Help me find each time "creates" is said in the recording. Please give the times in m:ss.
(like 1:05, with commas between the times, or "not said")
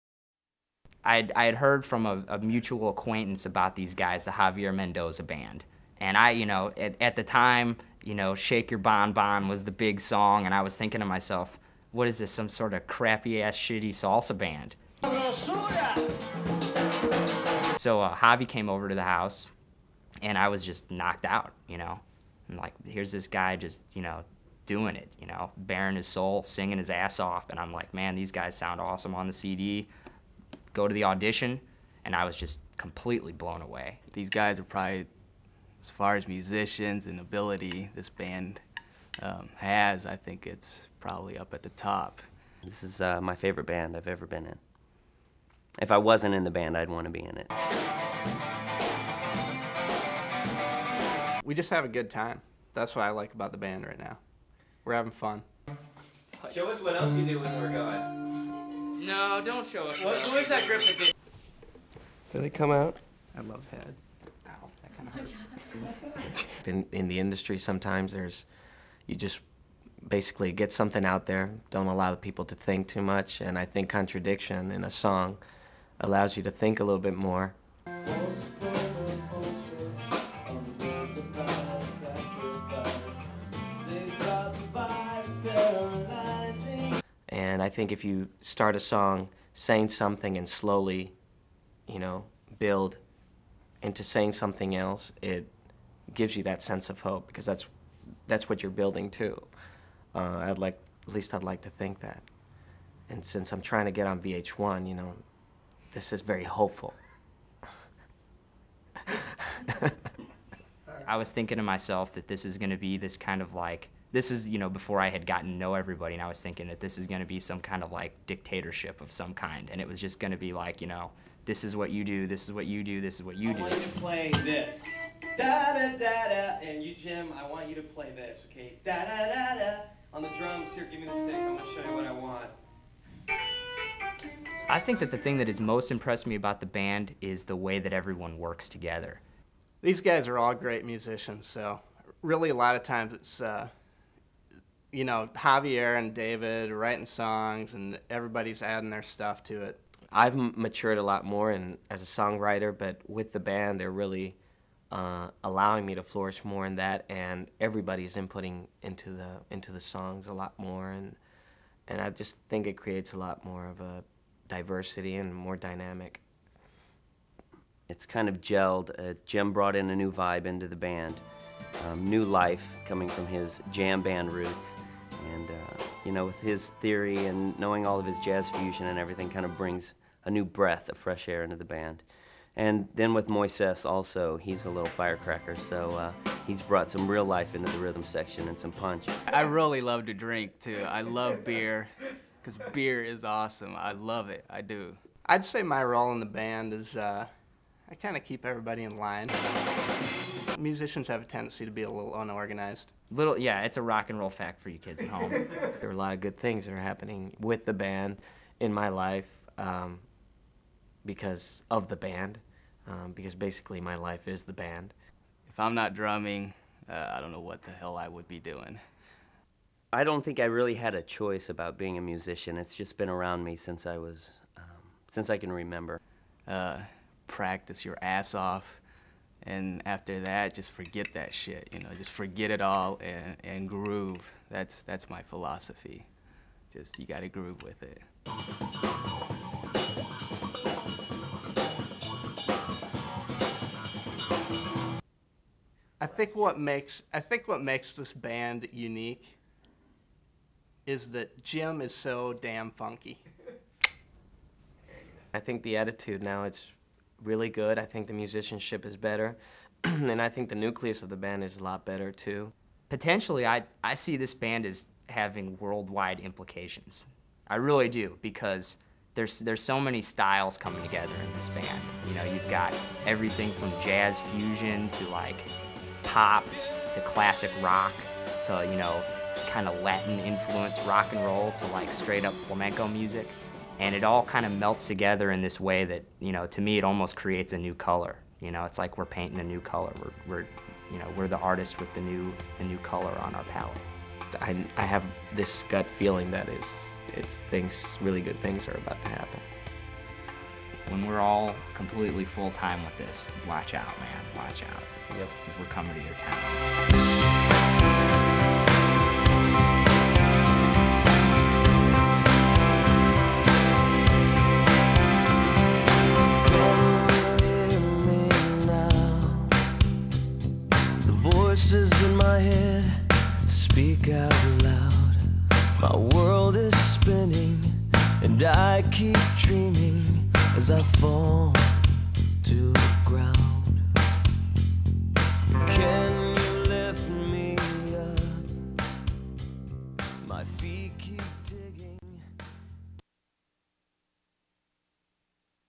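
2:42, 4:47.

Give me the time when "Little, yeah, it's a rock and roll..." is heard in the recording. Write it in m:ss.
3:23.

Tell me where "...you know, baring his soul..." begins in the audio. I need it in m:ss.
0:25.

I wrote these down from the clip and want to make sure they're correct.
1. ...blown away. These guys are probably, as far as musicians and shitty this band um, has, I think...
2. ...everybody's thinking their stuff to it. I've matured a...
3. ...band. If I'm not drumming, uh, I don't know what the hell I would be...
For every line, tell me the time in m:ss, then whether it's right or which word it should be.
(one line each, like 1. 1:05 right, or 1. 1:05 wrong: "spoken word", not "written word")
1. 0:33 wrong: "ability", not "shitty"
2. 2:28 wrong: "adding", not "thinking"
3. 3:34 right.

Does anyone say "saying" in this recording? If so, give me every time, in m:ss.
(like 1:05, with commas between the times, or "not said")
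1:29, 1:34.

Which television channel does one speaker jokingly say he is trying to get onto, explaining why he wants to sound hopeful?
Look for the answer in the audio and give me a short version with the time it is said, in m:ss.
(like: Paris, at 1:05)
VH1, at 1:44.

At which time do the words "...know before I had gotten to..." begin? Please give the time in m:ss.
1:54.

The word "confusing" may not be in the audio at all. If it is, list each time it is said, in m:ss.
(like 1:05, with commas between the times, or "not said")
not said.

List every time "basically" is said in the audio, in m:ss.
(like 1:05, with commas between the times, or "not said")
1:10, 3:33.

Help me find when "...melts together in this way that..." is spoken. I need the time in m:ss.
4:44.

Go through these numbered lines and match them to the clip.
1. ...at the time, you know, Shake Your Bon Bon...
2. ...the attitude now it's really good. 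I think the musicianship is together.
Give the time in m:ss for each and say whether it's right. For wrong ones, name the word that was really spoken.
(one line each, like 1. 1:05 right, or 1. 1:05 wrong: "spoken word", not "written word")
1. 0:07 right
2. 4:15 wrong: "better", not "together".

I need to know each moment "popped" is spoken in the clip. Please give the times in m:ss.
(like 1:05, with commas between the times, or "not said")
not said.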